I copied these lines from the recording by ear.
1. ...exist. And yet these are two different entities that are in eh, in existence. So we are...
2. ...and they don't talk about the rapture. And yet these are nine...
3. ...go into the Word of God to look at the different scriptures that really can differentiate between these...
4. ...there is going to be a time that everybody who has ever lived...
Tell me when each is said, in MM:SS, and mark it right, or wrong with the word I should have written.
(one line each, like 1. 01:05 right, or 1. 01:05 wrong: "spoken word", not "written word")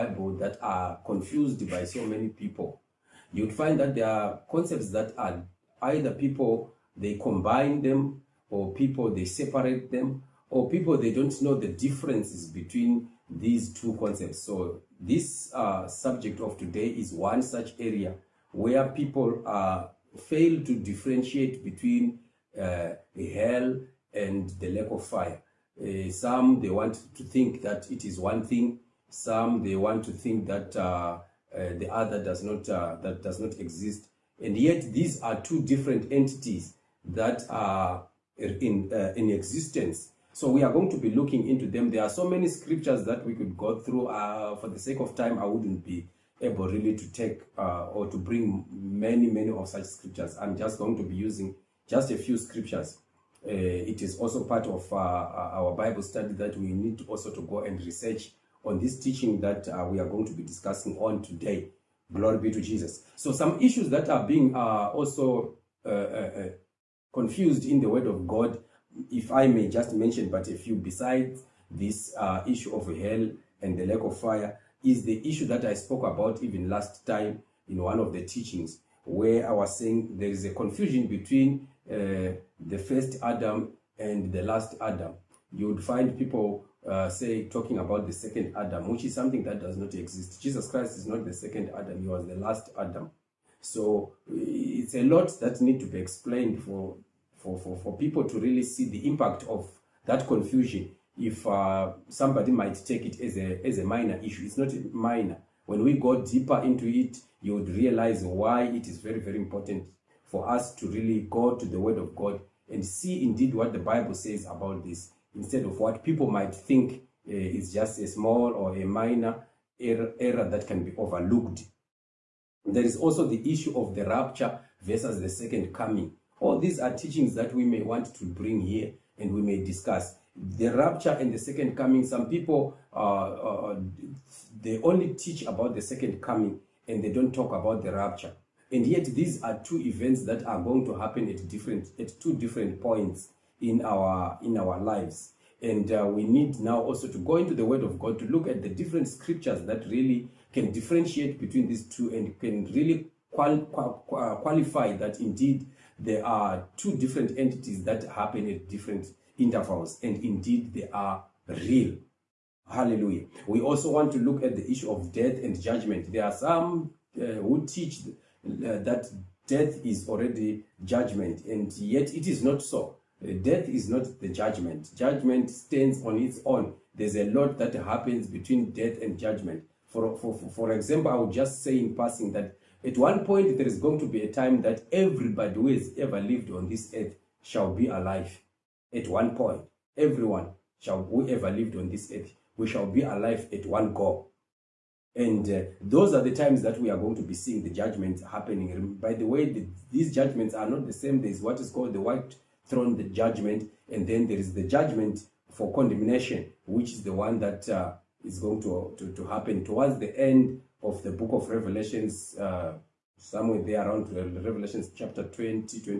1. 00:33 right
2. 02:16 wrong: "two", not "nine"
3. 02:27 right
4. 03:03 right.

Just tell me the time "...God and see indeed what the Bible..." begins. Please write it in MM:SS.
01:52.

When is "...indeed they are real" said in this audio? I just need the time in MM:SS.
02:40.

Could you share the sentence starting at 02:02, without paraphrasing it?
There is also the issue of the rapture versus the second coming.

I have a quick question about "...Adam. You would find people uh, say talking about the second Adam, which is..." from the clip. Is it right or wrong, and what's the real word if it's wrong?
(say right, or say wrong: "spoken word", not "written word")
right.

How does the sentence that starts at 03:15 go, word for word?
And uh, those are the times that we are going to be seeing the judgments happening.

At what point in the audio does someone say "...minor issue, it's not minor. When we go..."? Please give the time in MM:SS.
01:43.